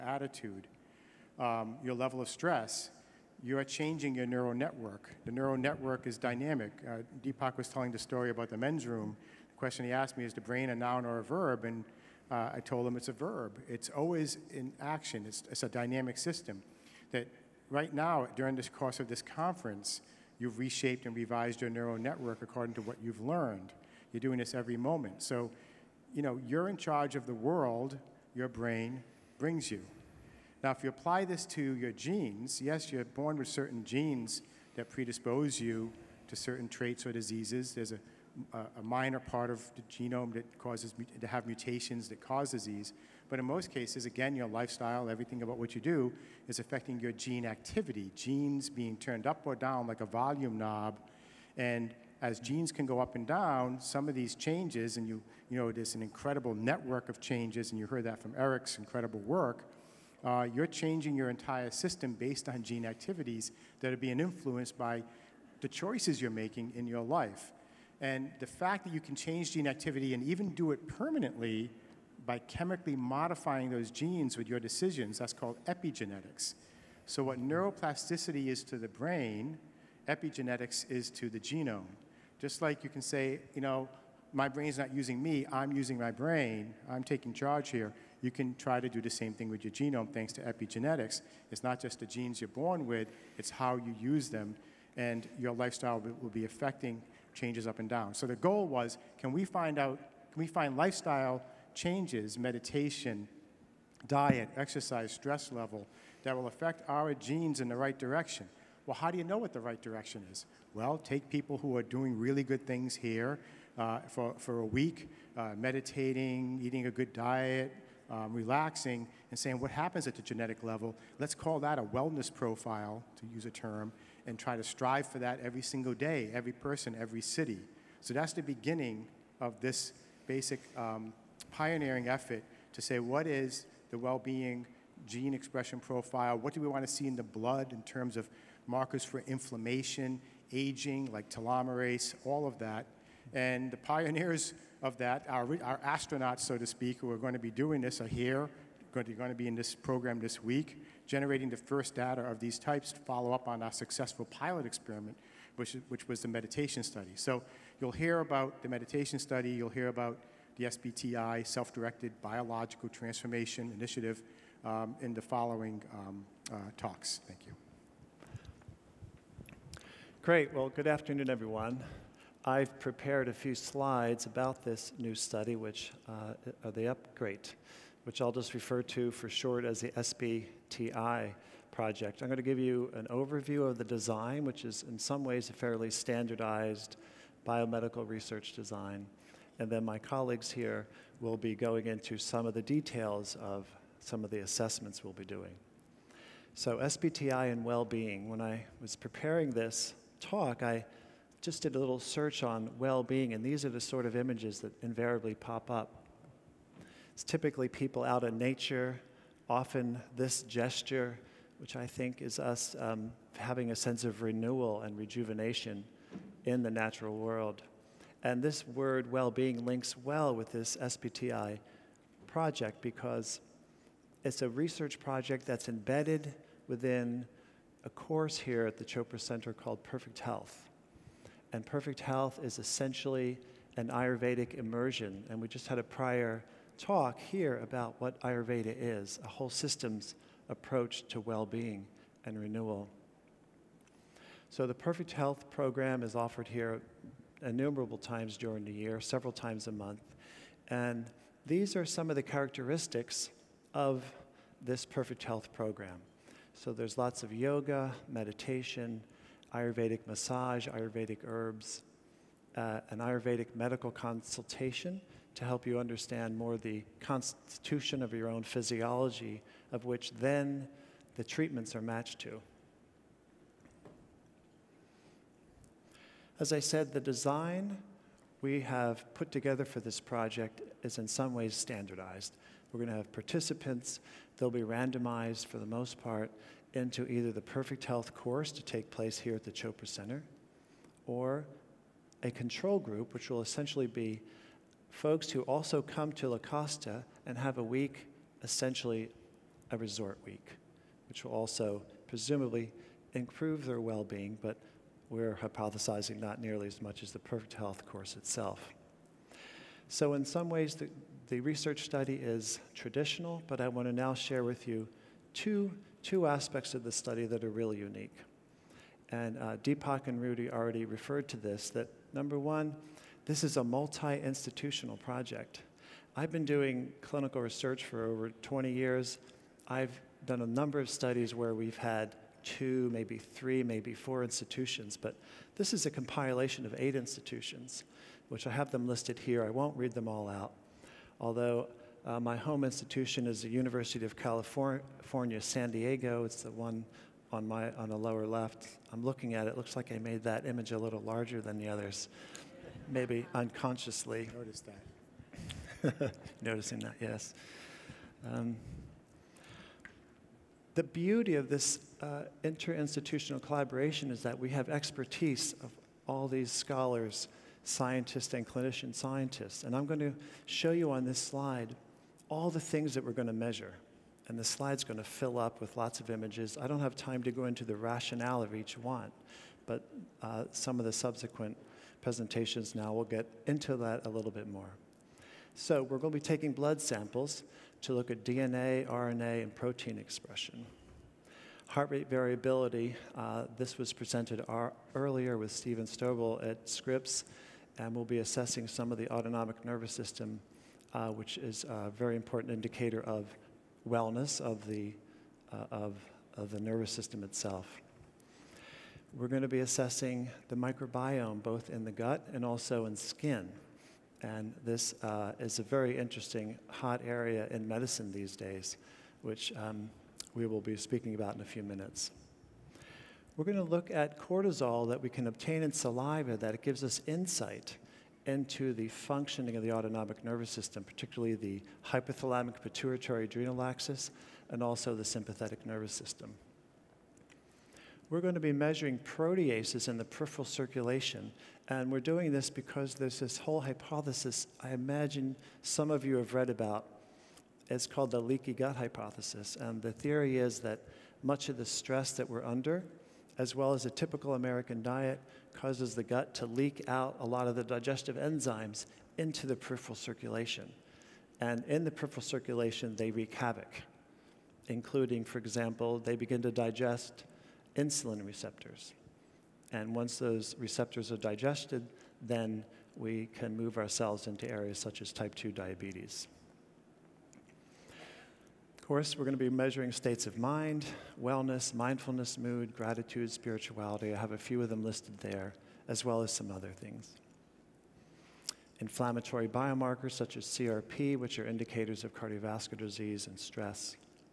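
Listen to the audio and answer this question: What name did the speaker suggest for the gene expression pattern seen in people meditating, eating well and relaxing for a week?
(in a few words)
wellness profile.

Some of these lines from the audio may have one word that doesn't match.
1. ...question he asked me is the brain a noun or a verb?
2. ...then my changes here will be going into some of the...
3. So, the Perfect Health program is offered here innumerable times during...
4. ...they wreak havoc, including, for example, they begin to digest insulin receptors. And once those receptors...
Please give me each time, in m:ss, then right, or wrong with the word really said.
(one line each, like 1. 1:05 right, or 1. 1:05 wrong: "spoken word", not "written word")
1. 0:09 right
2. 3:09 wrong: "colleagues", not "changes"
3. 4:04 right
4. 7:42 right.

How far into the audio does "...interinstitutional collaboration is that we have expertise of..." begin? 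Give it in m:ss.
6:02.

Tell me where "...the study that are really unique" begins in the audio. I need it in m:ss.
5:16.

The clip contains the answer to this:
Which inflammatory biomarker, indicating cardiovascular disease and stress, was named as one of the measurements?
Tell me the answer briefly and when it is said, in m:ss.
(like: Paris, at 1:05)
CRP, at 8:10.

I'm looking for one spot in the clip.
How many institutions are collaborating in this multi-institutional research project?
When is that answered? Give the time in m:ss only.
5:36.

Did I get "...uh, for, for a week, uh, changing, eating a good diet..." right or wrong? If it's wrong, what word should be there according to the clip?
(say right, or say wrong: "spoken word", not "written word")
wrong: "meditating", not "changing".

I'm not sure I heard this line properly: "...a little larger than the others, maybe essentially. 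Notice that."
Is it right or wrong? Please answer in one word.
wrong.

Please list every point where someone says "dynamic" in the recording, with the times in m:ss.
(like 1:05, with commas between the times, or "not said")
0:06, 0:15.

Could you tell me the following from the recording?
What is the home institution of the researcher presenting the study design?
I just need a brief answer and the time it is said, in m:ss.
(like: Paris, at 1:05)
University of California, San Diego, at 5:43.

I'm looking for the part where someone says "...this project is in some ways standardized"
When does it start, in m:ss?
4:39.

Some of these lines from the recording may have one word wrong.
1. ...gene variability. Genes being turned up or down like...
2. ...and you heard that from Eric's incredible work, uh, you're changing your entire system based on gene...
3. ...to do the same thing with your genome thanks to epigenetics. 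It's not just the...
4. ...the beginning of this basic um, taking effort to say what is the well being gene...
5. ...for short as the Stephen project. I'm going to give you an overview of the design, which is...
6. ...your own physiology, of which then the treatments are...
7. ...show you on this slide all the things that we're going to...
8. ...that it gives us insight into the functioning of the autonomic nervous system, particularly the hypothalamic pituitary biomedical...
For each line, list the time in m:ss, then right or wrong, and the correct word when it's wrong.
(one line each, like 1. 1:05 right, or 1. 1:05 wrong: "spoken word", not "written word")
1. 0:47 wrong: "activity", not "variability"
2. 0:57 right
3. 1:28 right
4. 2:08 wrong: "pioneering", not "taking"
5. 2:59 wrong: "SBTI", not "Stephen"
6. 4:28 right
7. 6:10 right
8. 7:06 wrong: "adrenal", not "biomedical".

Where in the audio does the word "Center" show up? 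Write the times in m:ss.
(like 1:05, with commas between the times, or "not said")
3:49, 4:49.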